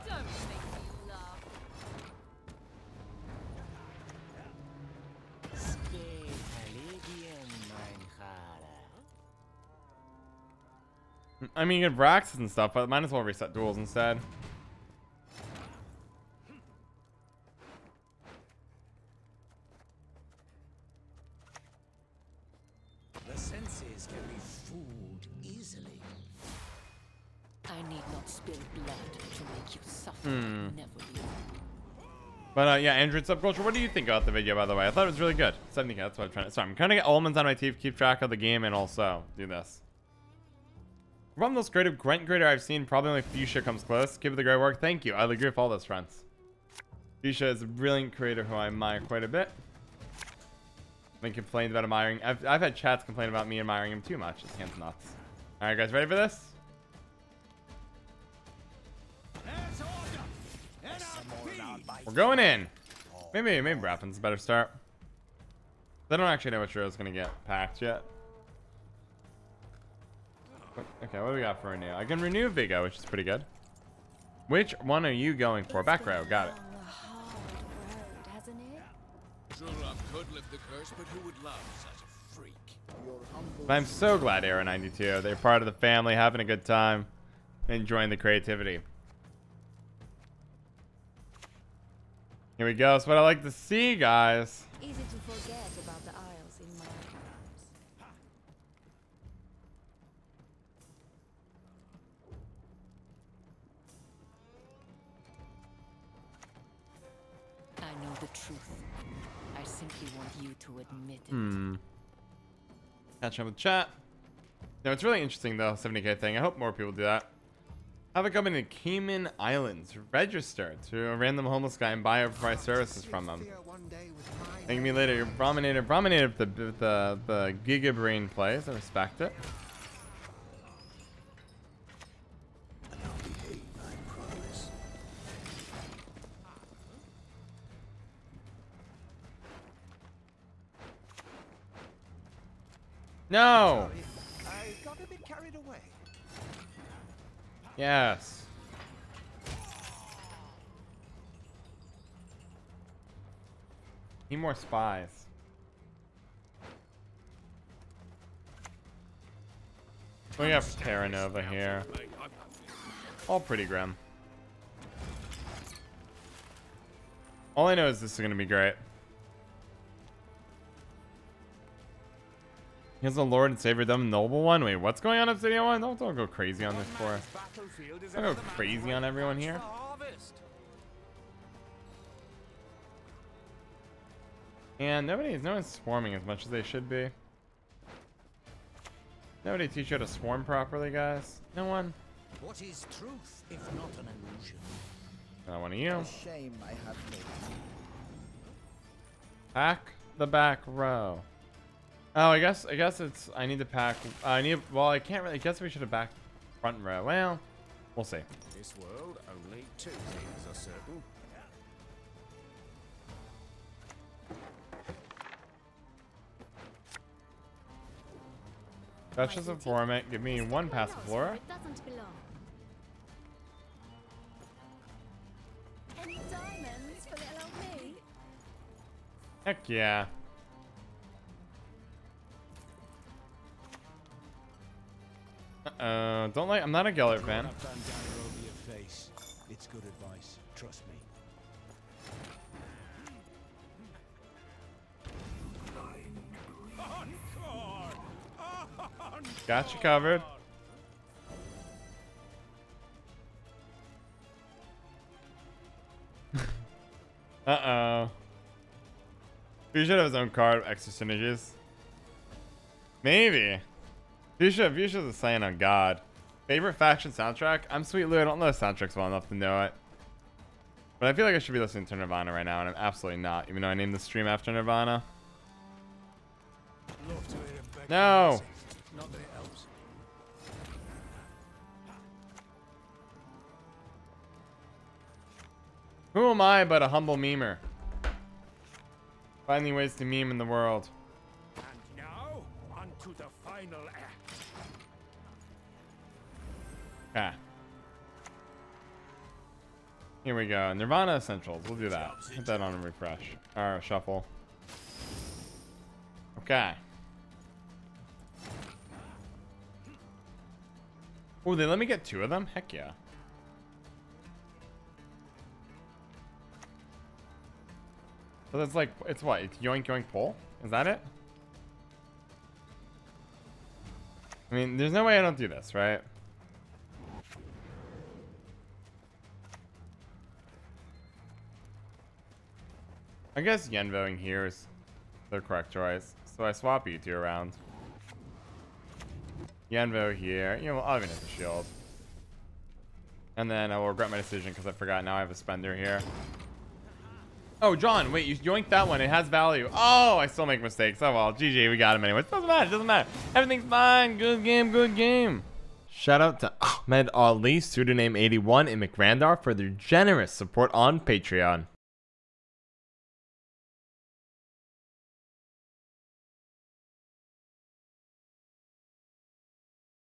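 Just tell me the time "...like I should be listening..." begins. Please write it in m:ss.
4:31.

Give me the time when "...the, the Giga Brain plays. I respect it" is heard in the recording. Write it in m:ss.
2:06.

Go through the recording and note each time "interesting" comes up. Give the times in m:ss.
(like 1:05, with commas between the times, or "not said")
1:55.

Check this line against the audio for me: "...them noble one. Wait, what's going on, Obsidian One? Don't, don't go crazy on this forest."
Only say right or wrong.
right.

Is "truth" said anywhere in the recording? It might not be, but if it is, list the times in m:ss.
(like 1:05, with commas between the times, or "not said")
1:48, 3:12.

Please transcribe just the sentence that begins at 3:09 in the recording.
Nobody teach you how to swarm properly, guys.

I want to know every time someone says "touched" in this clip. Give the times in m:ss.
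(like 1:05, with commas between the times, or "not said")
not said.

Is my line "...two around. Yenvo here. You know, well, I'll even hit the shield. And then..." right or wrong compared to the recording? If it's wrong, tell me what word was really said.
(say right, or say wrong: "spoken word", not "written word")
right.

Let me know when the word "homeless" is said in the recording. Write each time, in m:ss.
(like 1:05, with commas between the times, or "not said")
2:01.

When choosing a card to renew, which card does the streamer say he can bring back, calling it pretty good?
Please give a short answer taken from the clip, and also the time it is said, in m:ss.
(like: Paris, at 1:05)
Vigo, at 1:12.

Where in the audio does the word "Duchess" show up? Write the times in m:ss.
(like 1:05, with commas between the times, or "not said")
3:39.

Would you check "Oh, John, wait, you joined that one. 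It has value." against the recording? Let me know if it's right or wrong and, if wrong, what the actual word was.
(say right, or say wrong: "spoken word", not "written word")
right.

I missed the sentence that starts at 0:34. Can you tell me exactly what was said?
I thought it was really good.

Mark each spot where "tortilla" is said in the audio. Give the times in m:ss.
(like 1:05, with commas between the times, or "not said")
not said.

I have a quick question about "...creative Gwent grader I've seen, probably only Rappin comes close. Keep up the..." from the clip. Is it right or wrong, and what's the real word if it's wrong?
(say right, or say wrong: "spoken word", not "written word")
wrong: "Fuchsia", not "Rappin".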